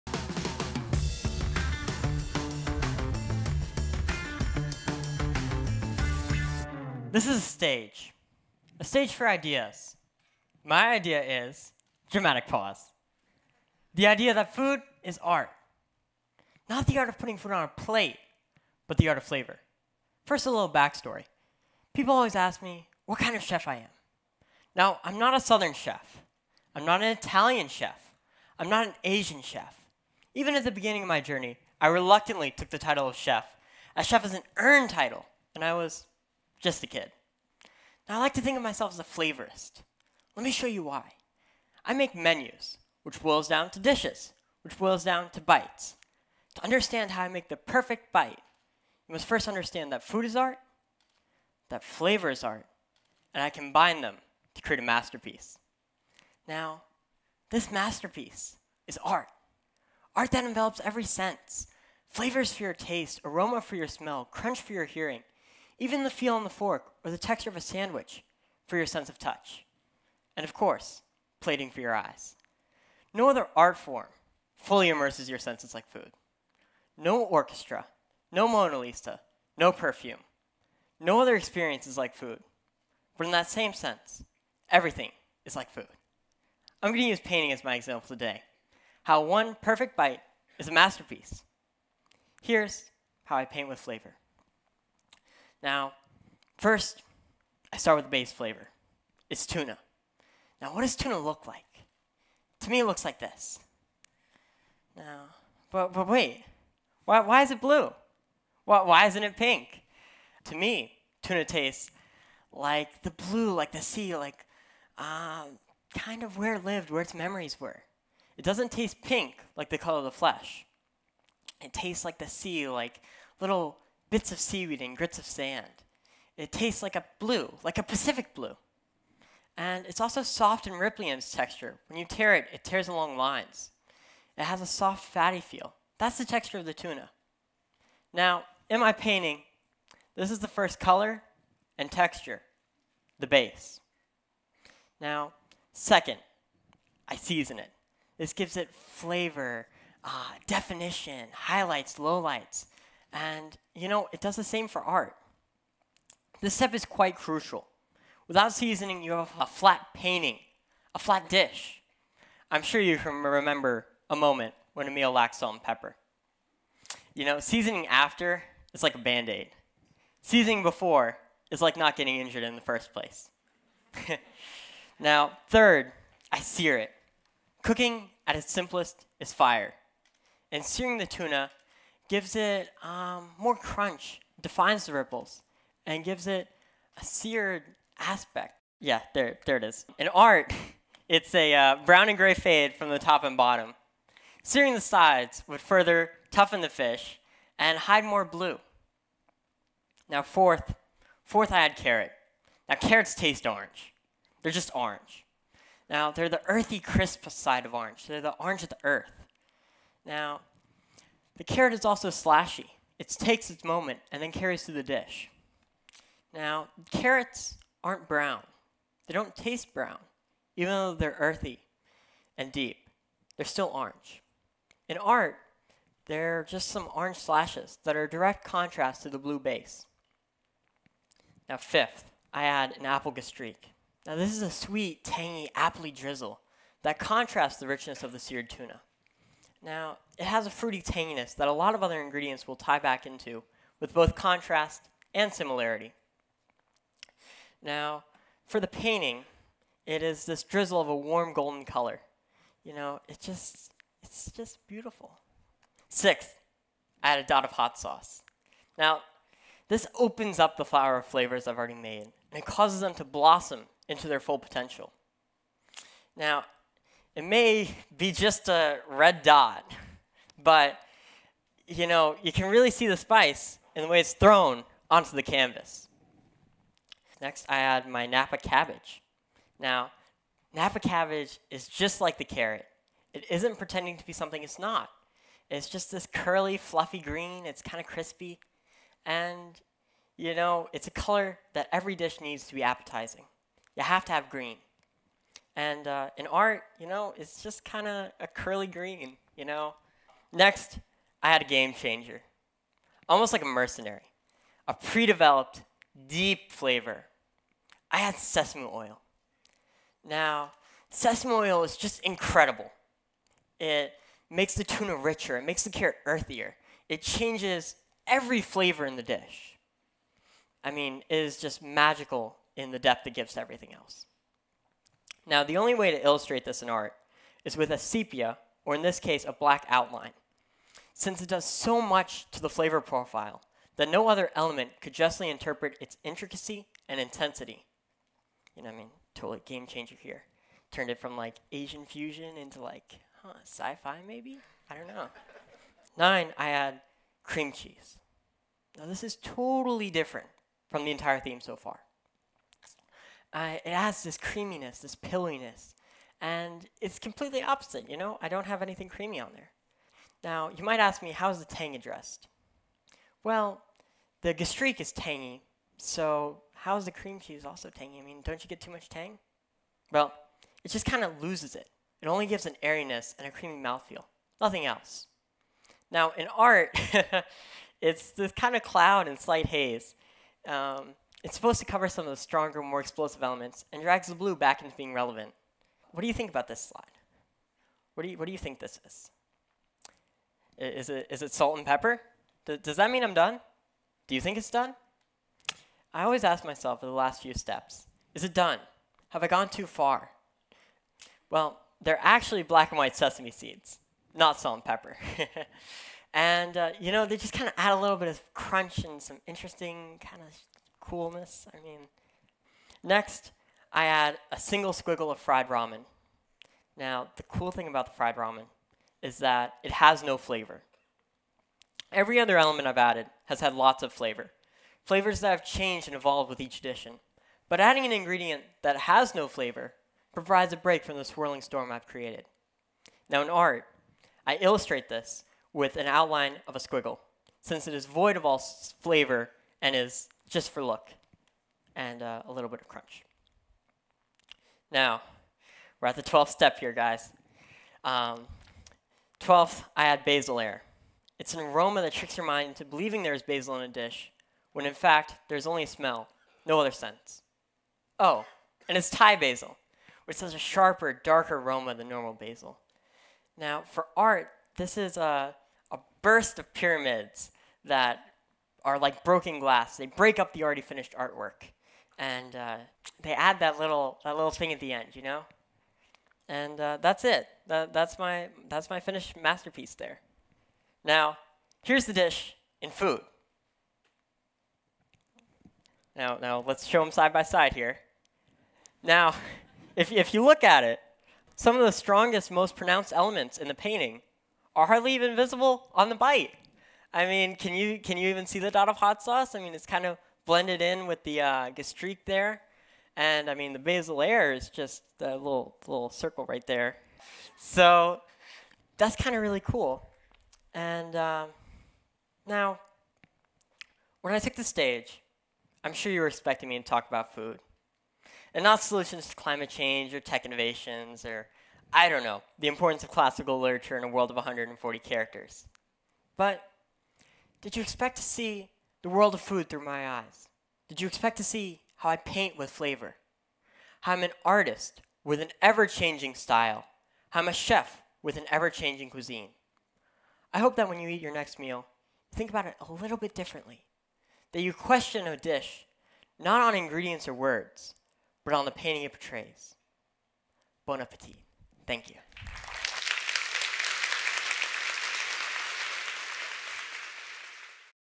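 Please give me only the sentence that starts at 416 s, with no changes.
Now, the cool thing about the fried ramen is that it has no flavor.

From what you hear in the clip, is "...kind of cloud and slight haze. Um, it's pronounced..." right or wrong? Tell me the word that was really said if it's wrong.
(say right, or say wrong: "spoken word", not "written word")
wrong: "supposed", not "pronounced".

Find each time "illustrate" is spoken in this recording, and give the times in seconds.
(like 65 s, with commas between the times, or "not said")
326 s, 434 s.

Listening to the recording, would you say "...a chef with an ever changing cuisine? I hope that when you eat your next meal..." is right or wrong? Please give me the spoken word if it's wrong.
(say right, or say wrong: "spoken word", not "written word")
right.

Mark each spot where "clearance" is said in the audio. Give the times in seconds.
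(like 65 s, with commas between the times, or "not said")
not said.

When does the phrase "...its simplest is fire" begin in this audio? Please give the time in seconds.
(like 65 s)
178 s.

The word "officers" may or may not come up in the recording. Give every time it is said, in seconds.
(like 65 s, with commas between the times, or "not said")
not said.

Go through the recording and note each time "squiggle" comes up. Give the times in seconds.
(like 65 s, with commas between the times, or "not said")
414 s, 436 s.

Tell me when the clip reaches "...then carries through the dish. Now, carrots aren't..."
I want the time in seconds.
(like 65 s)
214 s.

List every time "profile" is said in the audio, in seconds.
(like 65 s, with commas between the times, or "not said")
332 s.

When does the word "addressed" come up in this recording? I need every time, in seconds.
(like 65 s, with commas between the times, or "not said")
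361 s.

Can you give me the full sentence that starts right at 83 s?
But in that same sense, everything is like food.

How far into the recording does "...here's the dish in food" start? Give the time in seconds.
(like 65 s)
481 s.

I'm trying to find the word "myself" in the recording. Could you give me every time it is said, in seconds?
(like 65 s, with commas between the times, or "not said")
38 s, 396 s.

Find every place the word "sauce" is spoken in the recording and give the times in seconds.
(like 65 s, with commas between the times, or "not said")
257 s, 499 s.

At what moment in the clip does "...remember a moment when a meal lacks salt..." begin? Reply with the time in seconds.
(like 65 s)
163 s.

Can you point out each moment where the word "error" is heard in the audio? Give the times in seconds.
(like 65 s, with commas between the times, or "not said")
not said.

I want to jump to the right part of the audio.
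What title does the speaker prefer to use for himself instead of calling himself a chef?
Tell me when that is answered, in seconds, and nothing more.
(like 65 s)
39 s.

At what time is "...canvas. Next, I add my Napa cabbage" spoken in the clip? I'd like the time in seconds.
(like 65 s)
275 s.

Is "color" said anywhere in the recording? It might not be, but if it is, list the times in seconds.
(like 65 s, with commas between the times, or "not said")
119 s, 140 s, 251 s, 290 s.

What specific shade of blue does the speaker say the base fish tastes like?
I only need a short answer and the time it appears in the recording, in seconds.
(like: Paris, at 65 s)
Pacific blue, at 127 s.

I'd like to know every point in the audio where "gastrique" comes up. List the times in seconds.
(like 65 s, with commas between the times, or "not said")
233 s, 364 s, 501 s.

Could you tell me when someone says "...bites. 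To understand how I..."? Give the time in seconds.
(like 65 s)
45 s.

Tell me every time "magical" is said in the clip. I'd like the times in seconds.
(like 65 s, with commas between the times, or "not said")
321 s.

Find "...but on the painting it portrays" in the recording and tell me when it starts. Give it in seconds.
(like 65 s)
548 s.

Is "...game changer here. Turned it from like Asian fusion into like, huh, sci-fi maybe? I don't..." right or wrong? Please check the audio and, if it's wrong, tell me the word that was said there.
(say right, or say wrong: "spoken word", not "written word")
right.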